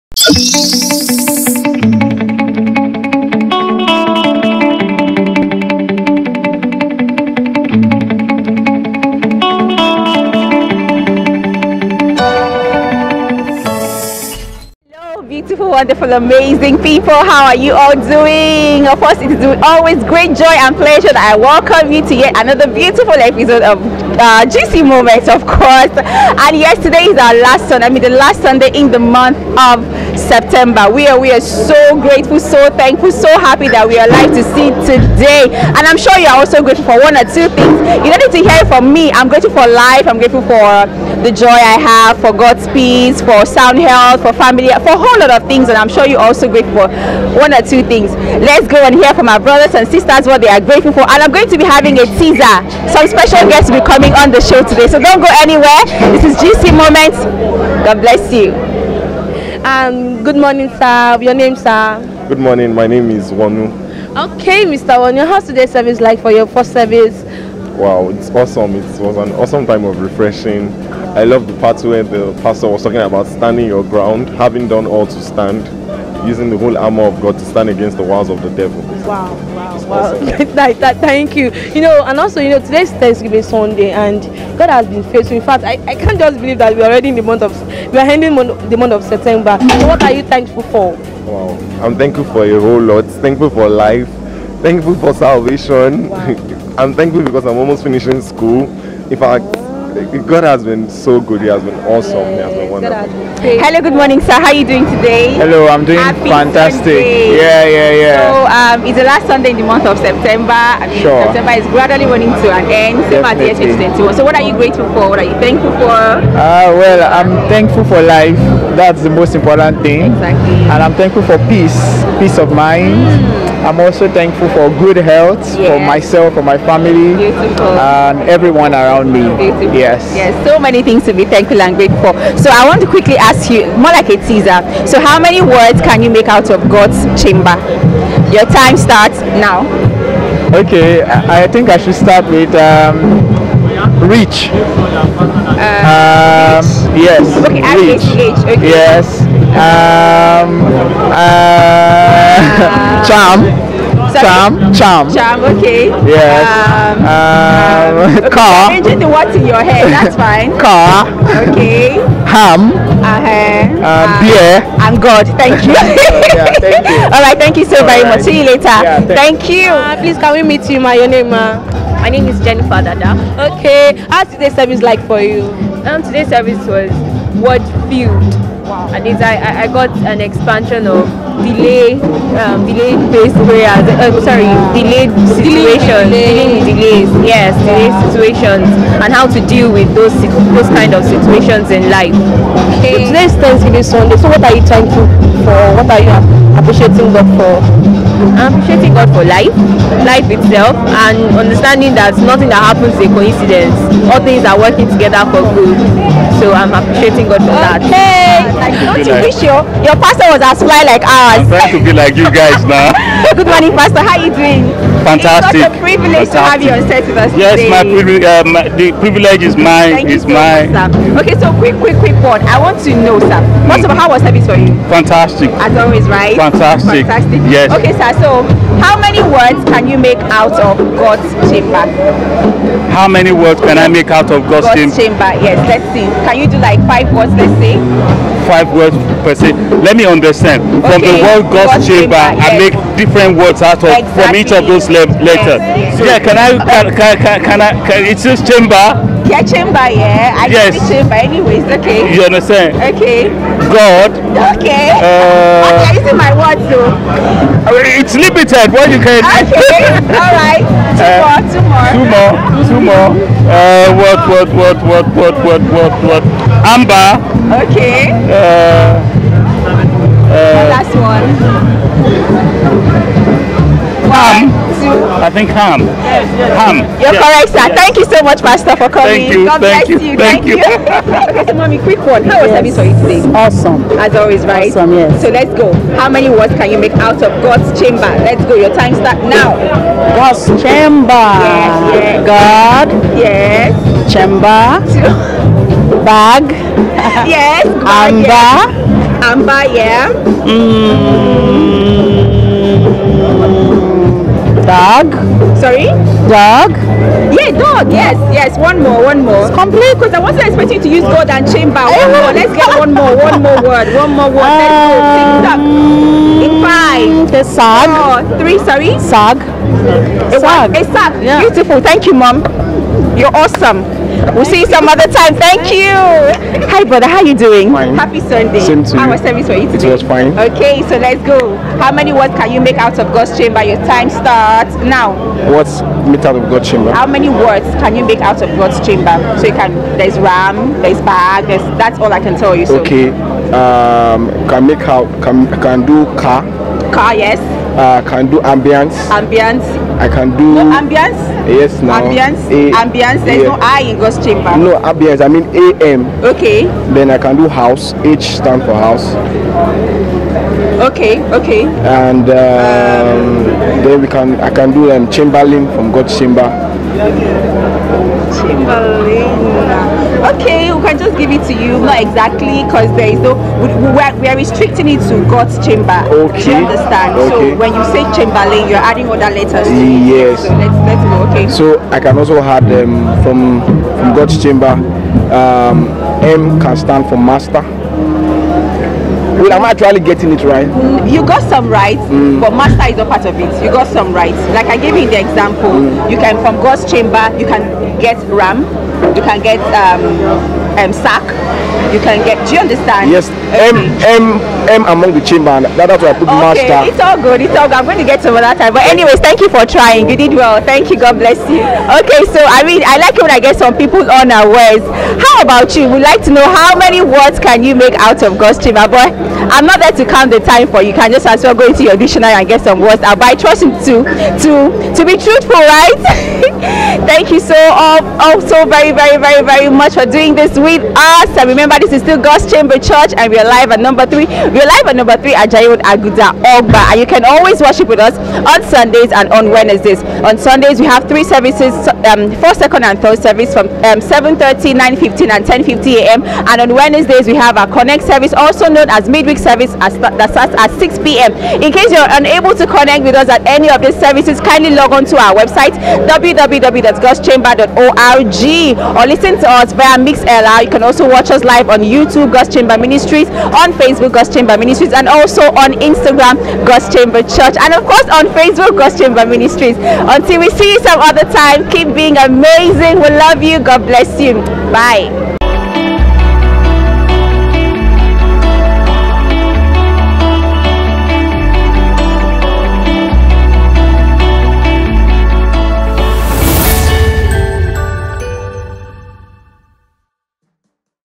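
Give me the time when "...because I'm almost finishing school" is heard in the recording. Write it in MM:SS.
01:37.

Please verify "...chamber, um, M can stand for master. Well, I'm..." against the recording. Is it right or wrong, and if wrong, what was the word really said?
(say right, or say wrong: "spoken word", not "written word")
right.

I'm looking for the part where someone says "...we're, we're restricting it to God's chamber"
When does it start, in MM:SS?
06:13.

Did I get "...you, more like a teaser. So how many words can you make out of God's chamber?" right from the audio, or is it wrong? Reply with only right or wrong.
right.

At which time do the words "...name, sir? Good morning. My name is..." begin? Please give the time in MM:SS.
01:01.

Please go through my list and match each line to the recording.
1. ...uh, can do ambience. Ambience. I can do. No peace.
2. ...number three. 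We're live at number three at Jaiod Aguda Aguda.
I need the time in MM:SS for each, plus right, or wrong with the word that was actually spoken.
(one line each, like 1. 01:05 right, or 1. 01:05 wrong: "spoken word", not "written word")
1. 05:47 wrong: "ambience", not "peace"
2. 07:13 wrong: "Ogba", not "Aguda".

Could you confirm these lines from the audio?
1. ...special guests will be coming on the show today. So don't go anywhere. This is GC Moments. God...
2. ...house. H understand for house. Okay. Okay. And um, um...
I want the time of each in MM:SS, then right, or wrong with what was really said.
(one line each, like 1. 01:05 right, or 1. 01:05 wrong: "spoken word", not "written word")
1. 00:53 right
2. 05:57 wrong: "stand", not "understand".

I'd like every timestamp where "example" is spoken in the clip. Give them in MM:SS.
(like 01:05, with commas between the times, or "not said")
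06:35.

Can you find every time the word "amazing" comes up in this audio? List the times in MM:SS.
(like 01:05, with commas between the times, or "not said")
00:16, 07:52.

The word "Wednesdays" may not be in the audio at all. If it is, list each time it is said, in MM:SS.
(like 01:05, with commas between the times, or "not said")
07:19, 07:26.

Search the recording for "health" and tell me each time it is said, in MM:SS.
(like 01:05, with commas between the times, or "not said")
00:43, 02:04.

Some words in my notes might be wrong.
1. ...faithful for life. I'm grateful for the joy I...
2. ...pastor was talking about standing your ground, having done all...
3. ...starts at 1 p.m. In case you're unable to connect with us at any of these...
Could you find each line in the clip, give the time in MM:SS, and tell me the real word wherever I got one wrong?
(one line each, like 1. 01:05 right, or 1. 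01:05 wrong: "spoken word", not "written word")
1. 00:39 wrong: "grateful", not "faithful"
2. 01:12 right
3. 07:30 wrong: "6", not "1".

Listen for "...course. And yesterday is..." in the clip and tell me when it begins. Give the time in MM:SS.
00:25.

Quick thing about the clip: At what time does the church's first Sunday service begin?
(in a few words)
7:30.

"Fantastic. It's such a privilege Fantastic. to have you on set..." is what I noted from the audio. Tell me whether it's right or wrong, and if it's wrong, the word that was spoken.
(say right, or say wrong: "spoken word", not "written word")
right.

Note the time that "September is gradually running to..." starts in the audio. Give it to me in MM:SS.
01:51.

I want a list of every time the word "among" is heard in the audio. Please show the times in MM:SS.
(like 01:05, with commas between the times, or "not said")
06:44.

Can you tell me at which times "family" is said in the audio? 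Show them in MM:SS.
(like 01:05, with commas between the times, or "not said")
00:44, 02:06.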